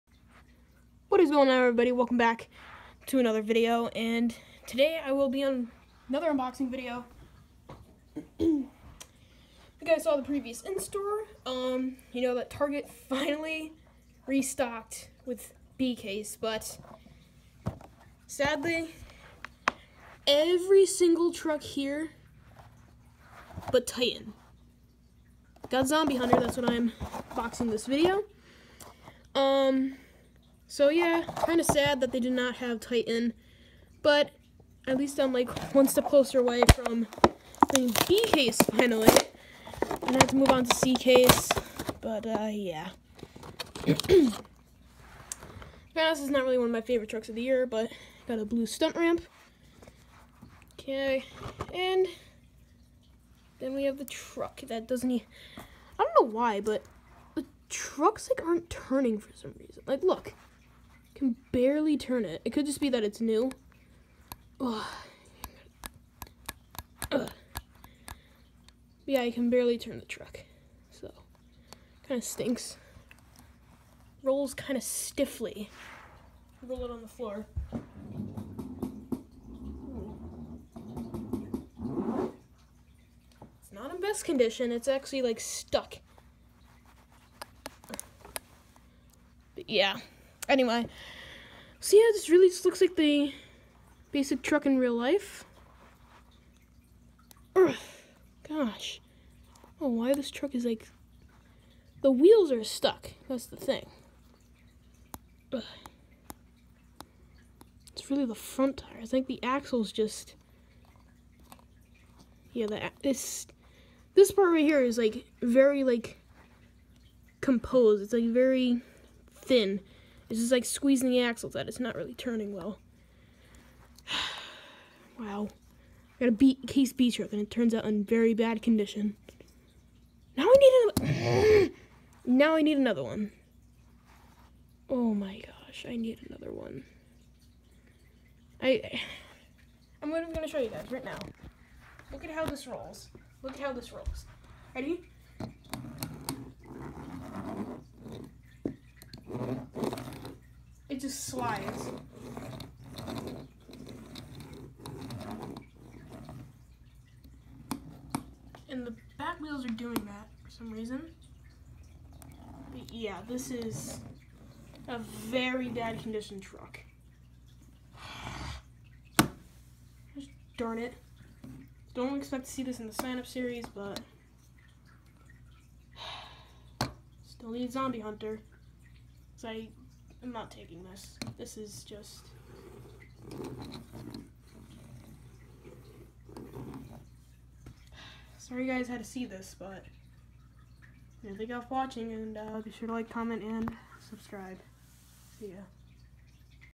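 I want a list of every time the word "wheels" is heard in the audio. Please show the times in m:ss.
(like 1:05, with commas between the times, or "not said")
1:42, 2:39.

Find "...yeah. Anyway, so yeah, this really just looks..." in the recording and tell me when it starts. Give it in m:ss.
1:29.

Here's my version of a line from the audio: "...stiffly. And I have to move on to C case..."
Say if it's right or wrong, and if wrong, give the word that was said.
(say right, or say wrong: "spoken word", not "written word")
wrong: "finally", not "stiffly".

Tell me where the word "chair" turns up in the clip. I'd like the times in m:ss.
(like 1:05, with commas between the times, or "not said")
not said.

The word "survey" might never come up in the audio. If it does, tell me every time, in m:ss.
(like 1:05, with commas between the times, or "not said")
not said.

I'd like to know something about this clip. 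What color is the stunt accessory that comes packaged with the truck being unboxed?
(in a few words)
Blue.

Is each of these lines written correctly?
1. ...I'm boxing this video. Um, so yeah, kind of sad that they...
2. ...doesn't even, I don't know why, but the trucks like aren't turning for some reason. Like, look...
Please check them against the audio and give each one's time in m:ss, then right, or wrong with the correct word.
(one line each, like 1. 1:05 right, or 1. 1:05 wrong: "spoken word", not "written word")
1. 0:26 right
2. 0:54 right.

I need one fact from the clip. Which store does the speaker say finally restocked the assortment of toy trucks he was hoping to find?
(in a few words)
Target.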